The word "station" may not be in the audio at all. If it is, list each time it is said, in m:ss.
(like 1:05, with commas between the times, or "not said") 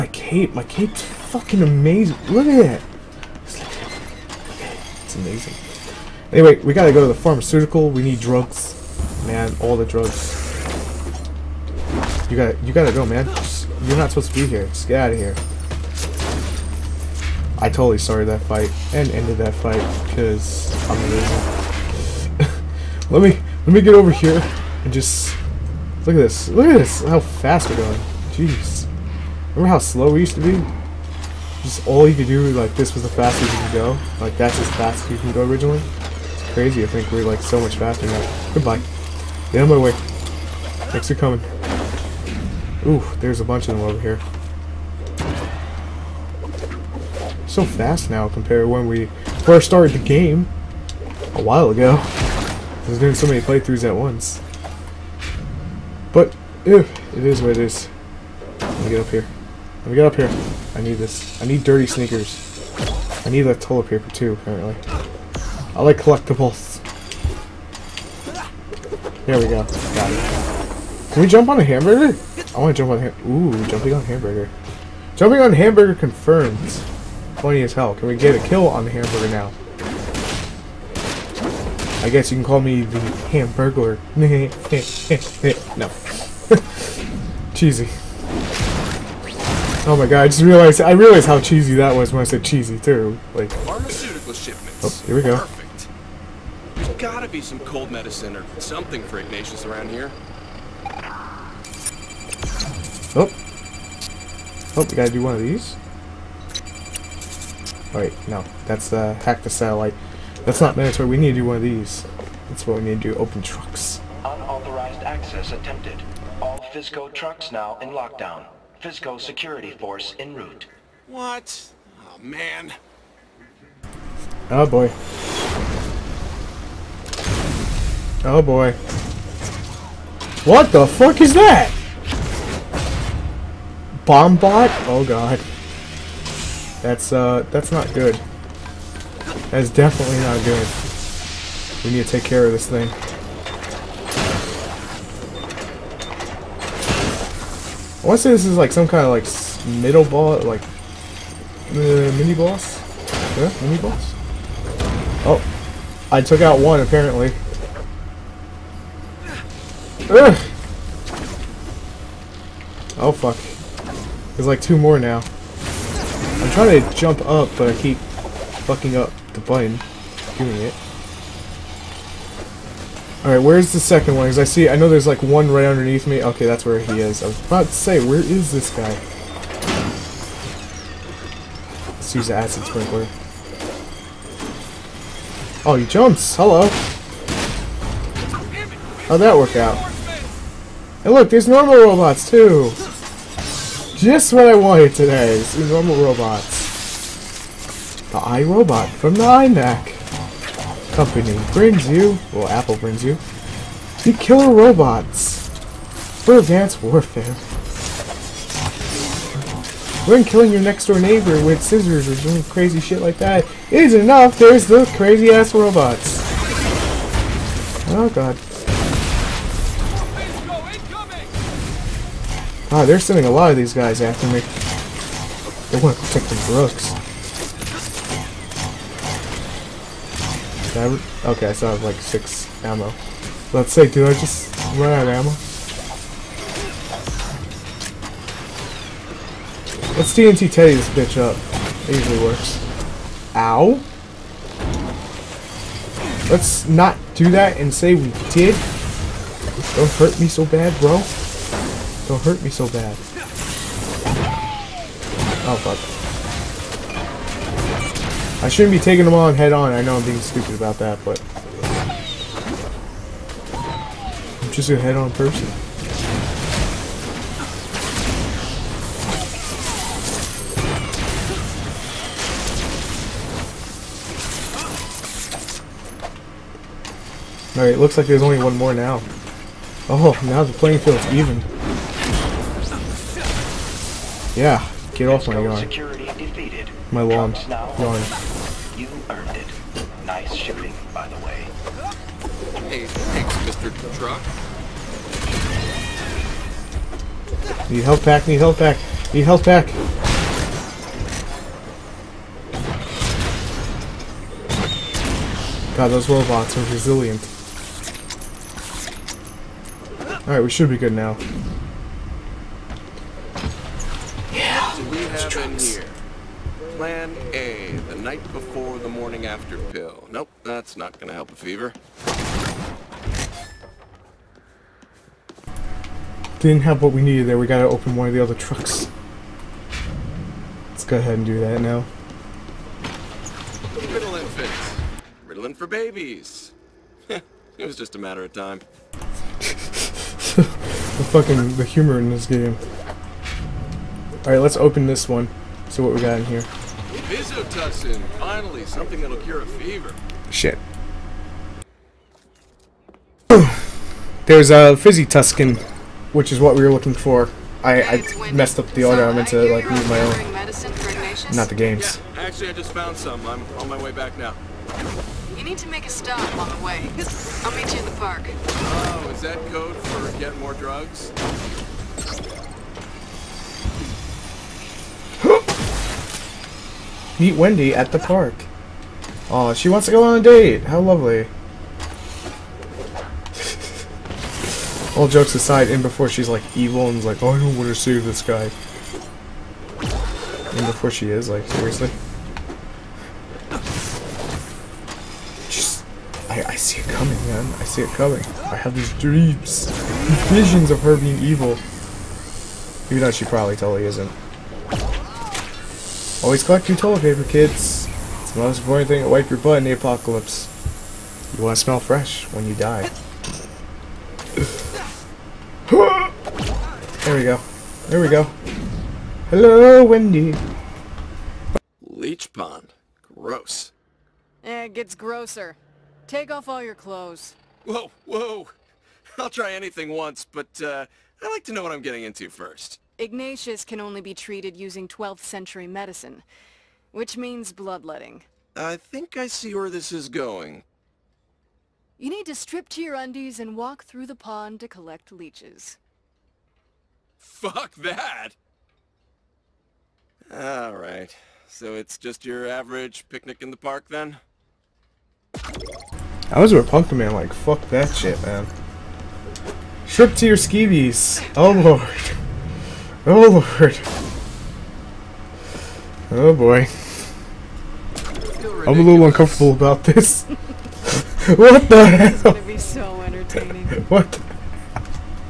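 not said.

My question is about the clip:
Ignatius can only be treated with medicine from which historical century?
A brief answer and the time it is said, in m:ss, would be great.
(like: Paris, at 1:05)
12th century, at 7:14.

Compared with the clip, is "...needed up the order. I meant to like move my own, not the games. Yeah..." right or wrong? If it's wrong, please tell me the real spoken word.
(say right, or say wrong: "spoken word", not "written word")
wrong: "messed", not "needed".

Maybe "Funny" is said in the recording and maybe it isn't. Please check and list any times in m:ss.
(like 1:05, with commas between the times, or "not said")
1:17.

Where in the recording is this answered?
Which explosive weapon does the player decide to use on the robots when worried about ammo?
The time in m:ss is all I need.
4:00.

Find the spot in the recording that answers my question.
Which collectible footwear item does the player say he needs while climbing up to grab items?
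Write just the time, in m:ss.
1:01.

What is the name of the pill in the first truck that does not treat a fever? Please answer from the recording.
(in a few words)
Plan A.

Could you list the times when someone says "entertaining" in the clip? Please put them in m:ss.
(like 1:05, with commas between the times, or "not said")
7:53.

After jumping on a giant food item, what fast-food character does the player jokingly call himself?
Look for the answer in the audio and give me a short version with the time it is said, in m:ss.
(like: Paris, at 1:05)
The Hamburglar, at 1:22.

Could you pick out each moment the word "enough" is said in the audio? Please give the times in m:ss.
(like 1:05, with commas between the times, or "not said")
3:33.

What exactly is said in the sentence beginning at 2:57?
I was about to say, where is this guy?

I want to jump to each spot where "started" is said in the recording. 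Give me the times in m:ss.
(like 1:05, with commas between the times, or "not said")
0:17, 0:49.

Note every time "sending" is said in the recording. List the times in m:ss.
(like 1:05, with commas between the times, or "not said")
3:42.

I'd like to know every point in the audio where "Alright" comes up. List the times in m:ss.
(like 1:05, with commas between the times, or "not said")
1:47, 2:53, 4:37, 5:10, 5:44, 7:30.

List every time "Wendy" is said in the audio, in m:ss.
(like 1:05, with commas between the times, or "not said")
6:17, 6:59.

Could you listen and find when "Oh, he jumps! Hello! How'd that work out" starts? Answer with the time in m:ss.
3:05.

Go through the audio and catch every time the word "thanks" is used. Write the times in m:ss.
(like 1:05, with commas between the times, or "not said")
0:40, 4:52.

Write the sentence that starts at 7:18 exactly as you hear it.
I think I see where this is going.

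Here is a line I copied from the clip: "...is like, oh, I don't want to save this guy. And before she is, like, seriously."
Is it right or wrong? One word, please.
right.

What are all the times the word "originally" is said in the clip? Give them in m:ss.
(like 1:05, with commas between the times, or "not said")
0:35.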